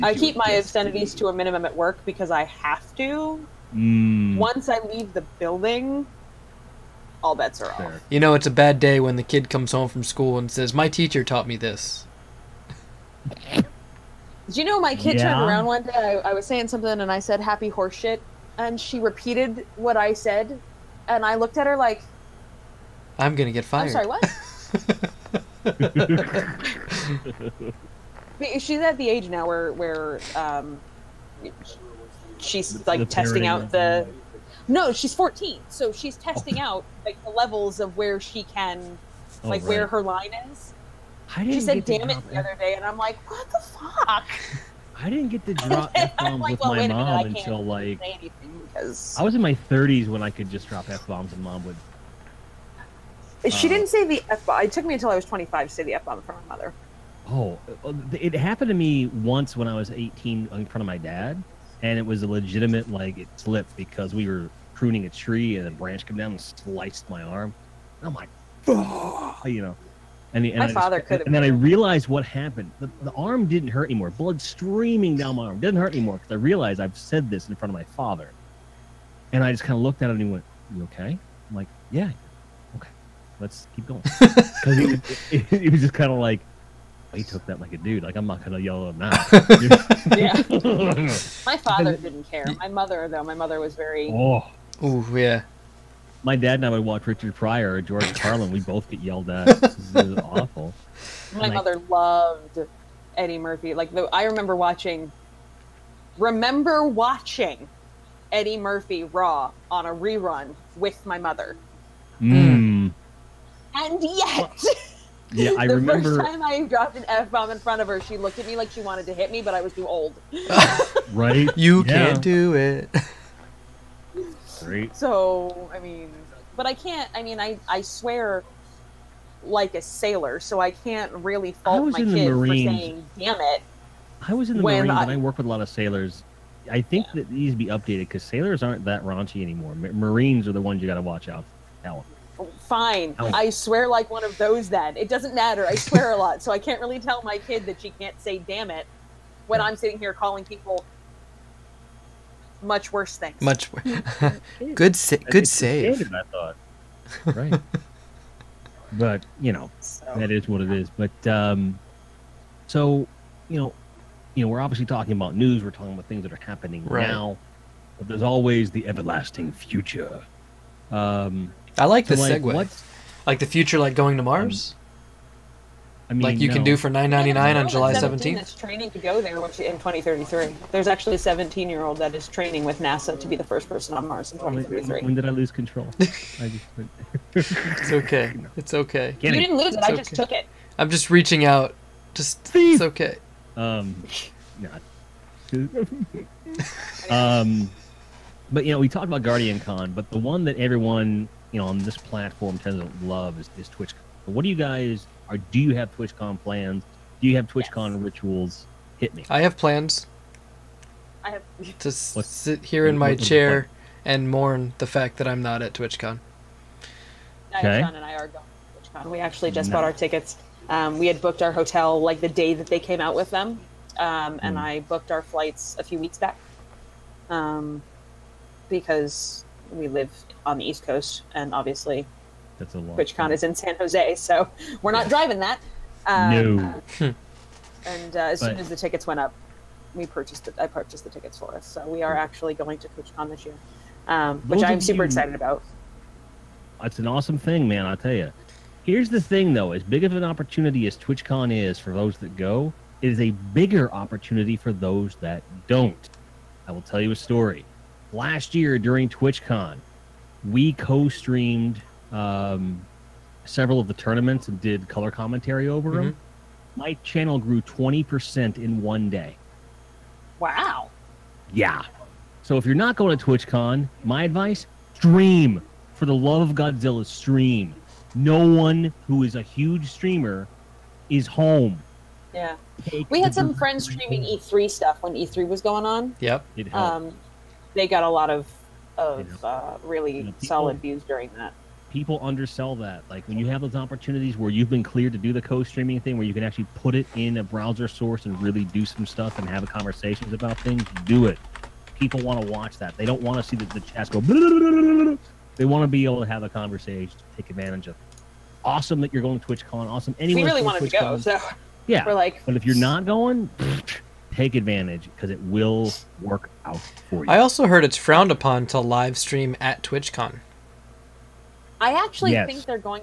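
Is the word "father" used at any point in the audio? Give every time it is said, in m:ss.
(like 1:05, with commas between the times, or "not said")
1:10, 1:17, 1:31.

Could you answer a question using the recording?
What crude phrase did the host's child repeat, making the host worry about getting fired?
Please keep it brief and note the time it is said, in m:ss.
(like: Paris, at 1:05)
happy horseshit, at 0:17.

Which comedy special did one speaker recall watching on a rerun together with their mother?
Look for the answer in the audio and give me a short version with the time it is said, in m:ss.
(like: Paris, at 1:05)
Eddie Murphy Raw, at 1:48.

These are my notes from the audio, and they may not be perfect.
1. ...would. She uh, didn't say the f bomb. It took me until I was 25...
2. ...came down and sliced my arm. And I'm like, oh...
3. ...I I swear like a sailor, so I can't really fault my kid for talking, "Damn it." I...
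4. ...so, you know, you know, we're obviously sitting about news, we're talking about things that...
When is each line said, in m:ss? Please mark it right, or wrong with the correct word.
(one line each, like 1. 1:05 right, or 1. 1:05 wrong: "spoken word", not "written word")
1. 0:51 right
2. 1:06 right
3. 2:07 wrong: "saying", not "talking"
4. 2:42 wrong: "talking", not "sitting".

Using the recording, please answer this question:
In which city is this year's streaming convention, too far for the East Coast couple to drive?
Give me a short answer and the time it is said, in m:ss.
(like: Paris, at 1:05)
San Jose, at 3:53.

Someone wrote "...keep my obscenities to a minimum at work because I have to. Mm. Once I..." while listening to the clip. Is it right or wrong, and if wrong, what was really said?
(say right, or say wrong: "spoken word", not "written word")
right.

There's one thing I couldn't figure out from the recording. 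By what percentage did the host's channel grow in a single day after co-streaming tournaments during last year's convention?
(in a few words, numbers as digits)
20 percent.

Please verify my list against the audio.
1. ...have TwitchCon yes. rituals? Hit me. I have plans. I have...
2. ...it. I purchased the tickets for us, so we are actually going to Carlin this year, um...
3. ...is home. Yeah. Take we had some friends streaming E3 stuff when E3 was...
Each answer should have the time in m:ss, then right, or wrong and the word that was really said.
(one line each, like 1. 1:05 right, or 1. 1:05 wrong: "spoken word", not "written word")
1. 3:27 right
2. 4:00 wrong: "TwitchCon", not "Carlin"
3. 4:41 right.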